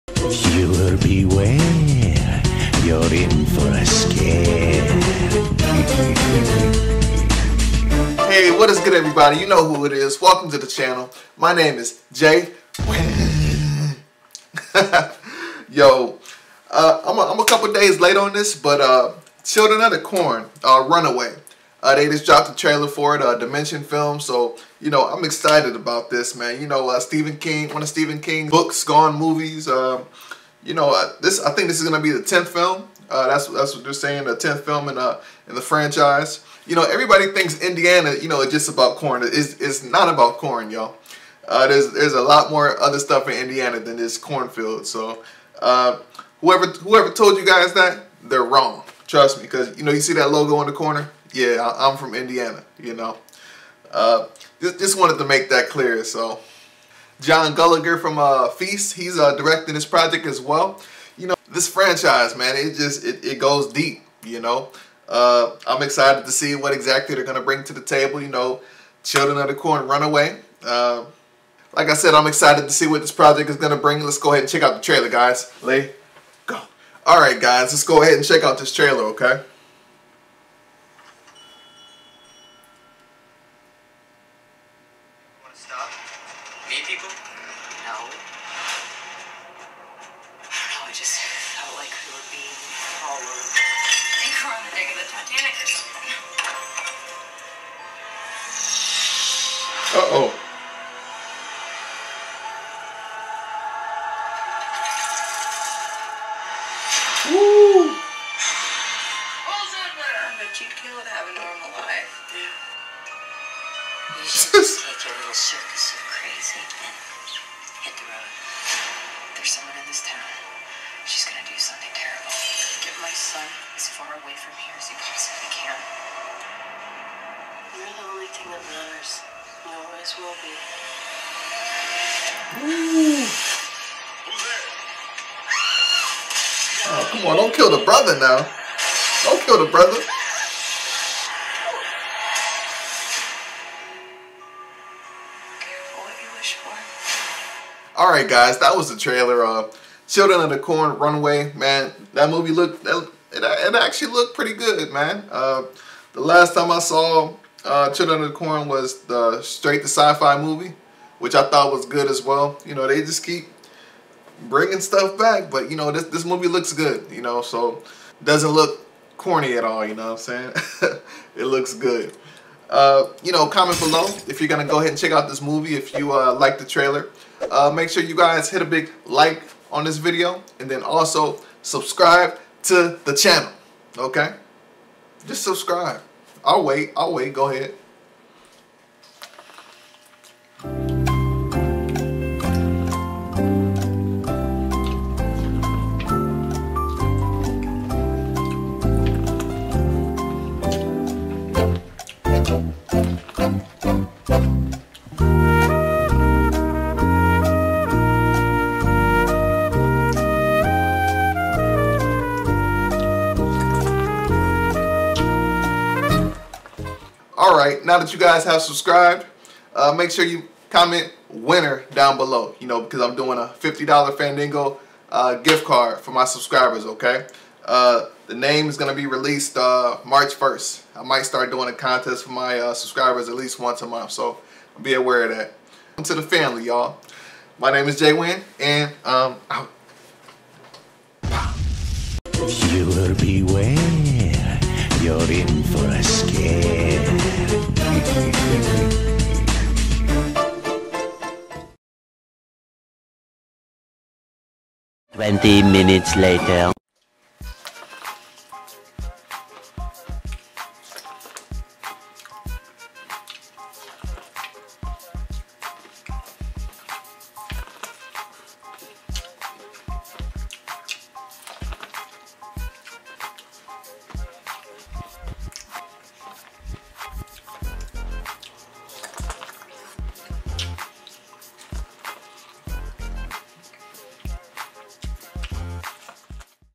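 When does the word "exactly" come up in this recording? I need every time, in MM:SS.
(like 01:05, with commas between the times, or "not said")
01:06.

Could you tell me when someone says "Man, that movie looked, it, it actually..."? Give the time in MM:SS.
02:31.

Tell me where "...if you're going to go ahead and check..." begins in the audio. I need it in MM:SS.
02:54.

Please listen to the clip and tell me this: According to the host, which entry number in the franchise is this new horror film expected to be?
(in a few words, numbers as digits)
10th.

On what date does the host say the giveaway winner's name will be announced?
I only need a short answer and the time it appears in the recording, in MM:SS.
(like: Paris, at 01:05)
March 1st, at 03:50.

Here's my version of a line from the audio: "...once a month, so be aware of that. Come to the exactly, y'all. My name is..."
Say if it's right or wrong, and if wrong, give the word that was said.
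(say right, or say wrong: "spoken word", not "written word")
wrong: "family", not "exactly".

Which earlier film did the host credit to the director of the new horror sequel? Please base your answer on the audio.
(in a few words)
Feast.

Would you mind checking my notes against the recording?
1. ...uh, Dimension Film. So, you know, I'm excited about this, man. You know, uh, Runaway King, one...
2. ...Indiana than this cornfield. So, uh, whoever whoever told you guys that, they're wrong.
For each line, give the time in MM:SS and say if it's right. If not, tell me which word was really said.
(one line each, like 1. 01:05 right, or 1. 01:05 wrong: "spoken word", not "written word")
1. 00:23 wrong: "Stephen", not "Runaway"
2. 00:43 right.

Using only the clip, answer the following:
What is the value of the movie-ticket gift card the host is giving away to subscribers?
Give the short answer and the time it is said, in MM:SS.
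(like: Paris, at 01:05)
$50, at 03:43.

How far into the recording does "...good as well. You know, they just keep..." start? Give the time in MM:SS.
02:41.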